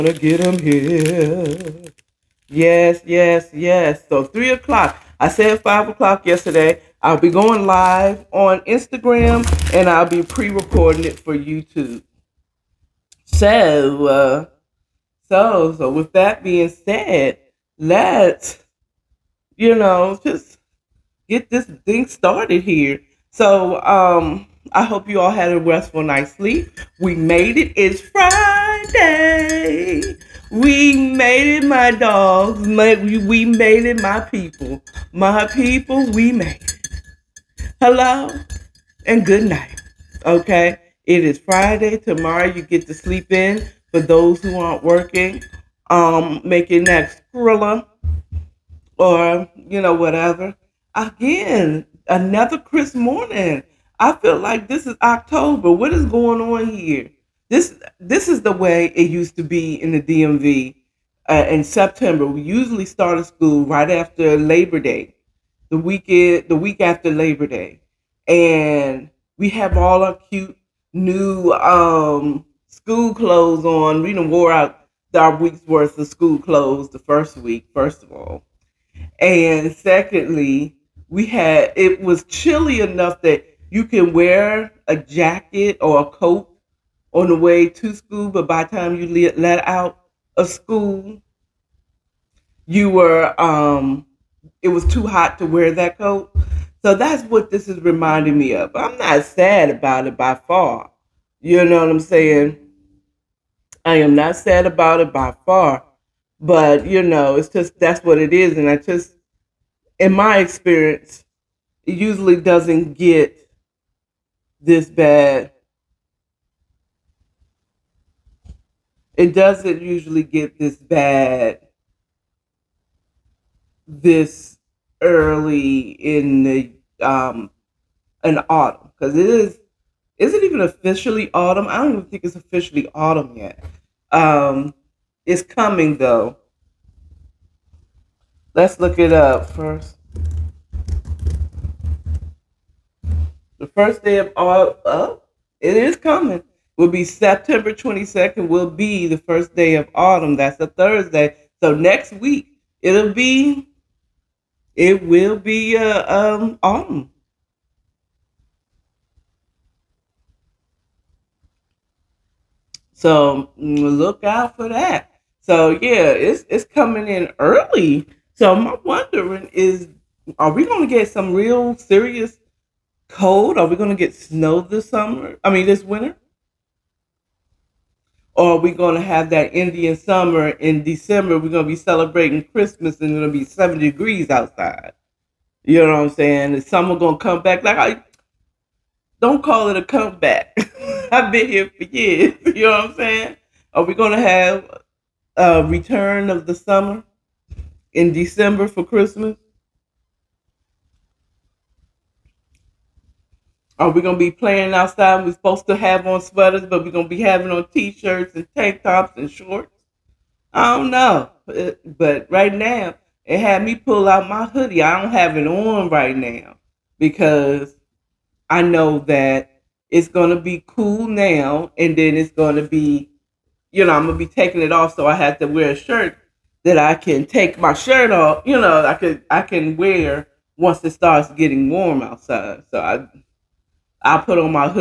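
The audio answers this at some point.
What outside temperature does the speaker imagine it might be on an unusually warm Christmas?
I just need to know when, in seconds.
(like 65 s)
183 s.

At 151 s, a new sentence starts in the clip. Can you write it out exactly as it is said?
So next week, it'll be, it will be uh, um, autumn.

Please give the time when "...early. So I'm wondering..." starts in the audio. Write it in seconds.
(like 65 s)
167 s.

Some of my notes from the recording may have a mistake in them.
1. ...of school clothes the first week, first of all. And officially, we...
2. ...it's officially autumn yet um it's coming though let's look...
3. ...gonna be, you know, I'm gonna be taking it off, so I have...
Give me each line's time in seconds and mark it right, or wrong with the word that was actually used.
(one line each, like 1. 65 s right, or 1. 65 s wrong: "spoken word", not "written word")
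1. 75 s wrong: "secondly", not "officially"
2. 132 s right
3. 222 s right.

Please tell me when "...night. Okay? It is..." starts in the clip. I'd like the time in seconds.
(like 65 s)
39 s.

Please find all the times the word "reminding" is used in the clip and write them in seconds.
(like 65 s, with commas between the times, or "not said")
97 s.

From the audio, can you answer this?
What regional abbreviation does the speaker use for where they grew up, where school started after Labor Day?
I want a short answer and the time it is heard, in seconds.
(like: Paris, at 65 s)
DMV, at 60 s.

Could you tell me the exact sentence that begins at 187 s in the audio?
Like, I don't call it a comeback.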